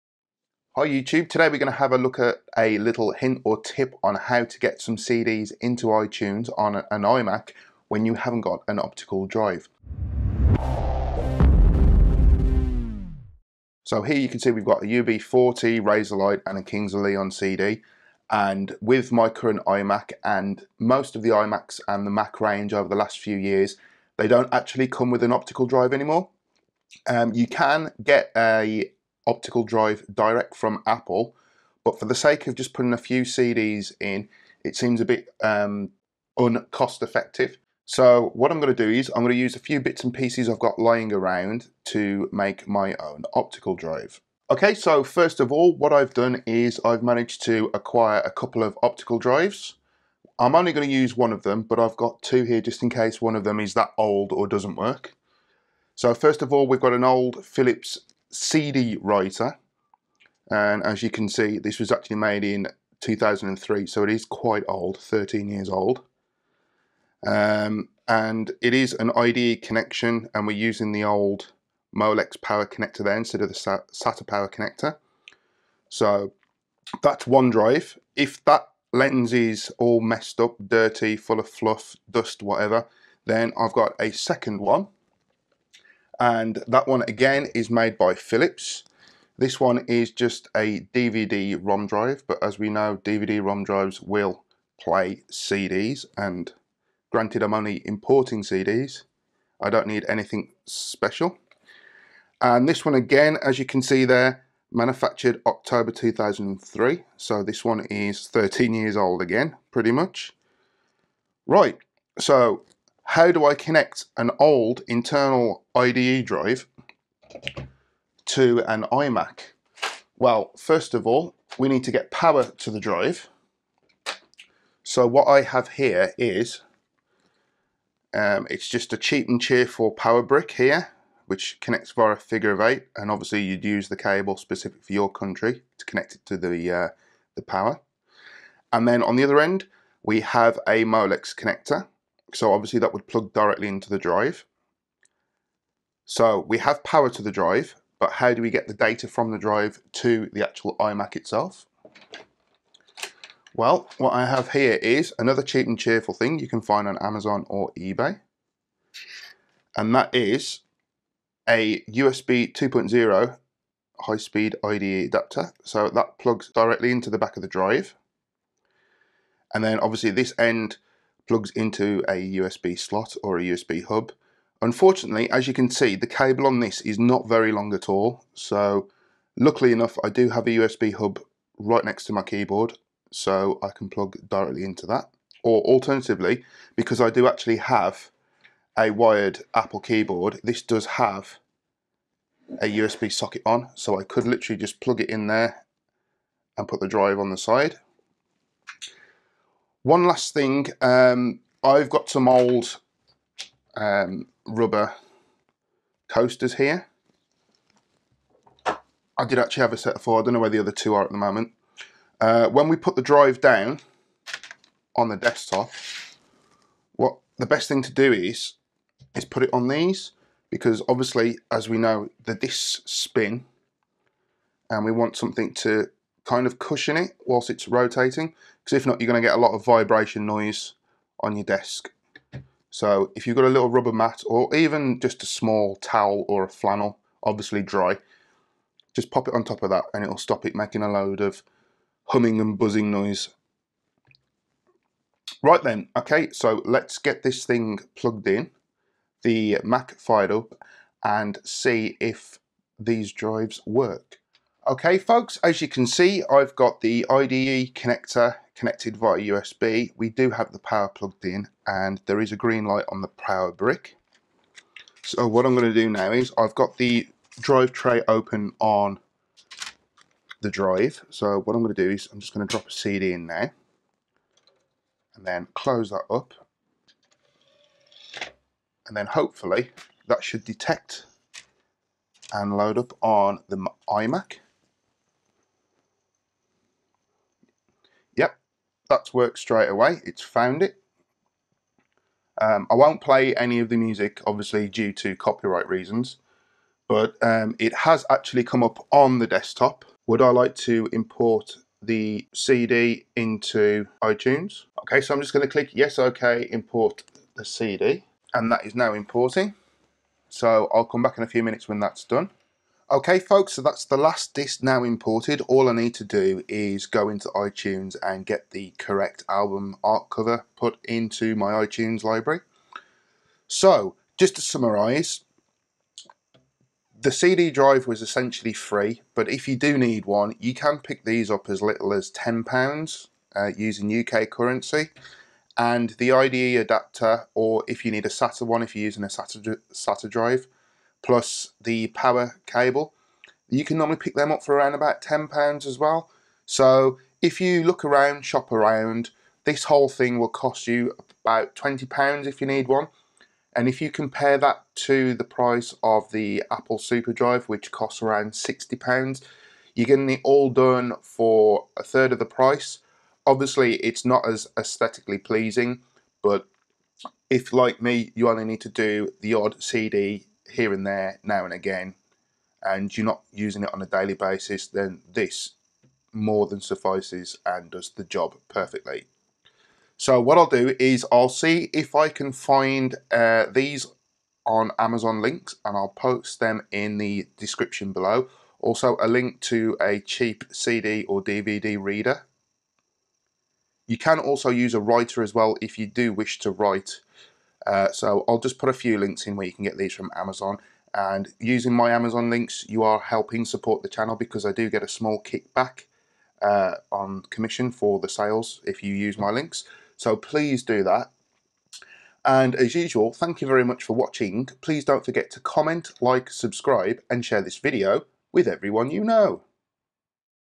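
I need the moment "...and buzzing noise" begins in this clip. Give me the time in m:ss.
4:02.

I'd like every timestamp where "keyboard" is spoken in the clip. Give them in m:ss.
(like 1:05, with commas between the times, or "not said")
3:02, 3:09.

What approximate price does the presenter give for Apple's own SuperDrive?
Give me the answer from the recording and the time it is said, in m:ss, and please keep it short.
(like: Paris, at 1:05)
£60, at 5:58.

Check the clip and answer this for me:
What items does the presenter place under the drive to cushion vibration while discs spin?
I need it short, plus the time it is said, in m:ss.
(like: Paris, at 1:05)
rubber coasters, at 3:24.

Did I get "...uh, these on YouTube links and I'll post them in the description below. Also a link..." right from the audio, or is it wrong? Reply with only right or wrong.
wrong.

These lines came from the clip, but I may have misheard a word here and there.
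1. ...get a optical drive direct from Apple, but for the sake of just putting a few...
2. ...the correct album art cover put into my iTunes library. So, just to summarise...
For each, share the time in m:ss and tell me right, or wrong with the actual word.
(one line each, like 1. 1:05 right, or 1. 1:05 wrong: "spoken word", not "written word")
1. 0:28 right
2. 5:18 right.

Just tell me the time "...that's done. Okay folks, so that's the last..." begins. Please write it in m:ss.
5:11.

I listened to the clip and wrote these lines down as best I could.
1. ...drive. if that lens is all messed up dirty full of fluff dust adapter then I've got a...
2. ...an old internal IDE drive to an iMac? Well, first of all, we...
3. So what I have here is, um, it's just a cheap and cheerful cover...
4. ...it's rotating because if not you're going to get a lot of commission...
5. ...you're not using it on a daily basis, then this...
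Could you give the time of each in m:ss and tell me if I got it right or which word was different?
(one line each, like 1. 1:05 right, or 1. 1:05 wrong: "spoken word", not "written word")
1. 1:17 wrong: "whatever", not "adapter"
2. 1:54 right
3. 2:04 wrong: "power", not "cover"
4. 3:47 wrong: "vibration", not "commission"
5. 6:12 right.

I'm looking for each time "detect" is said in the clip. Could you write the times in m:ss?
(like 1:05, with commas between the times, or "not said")
4:40.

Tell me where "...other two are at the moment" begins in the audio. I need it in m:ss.
3:30.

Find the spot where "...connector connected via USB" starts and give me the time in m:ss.
4:17.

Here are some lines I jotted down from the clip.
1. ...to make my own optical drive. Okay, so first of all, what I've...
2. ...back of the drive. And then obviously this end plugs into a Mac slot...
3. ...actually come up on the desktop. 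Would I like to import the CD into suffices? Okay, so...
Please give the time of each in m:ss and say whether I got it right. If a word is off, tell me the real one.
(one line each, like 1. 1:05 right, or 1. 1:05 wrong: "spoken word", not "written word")
1. 0:41 right
2. 2:47 wrong: "USB", not "Mac"
3. 4:58 wrong: "iTunes", not "suffices".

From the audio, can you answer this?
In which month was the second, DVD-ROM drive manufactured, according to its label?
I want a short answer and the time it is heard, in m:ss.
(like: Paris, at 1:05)
October, at 1:45.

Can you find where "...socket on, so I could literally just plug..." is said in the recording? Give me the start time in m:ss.
3:13.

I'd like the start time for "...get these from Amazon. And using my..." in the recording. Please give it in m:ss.
6:39.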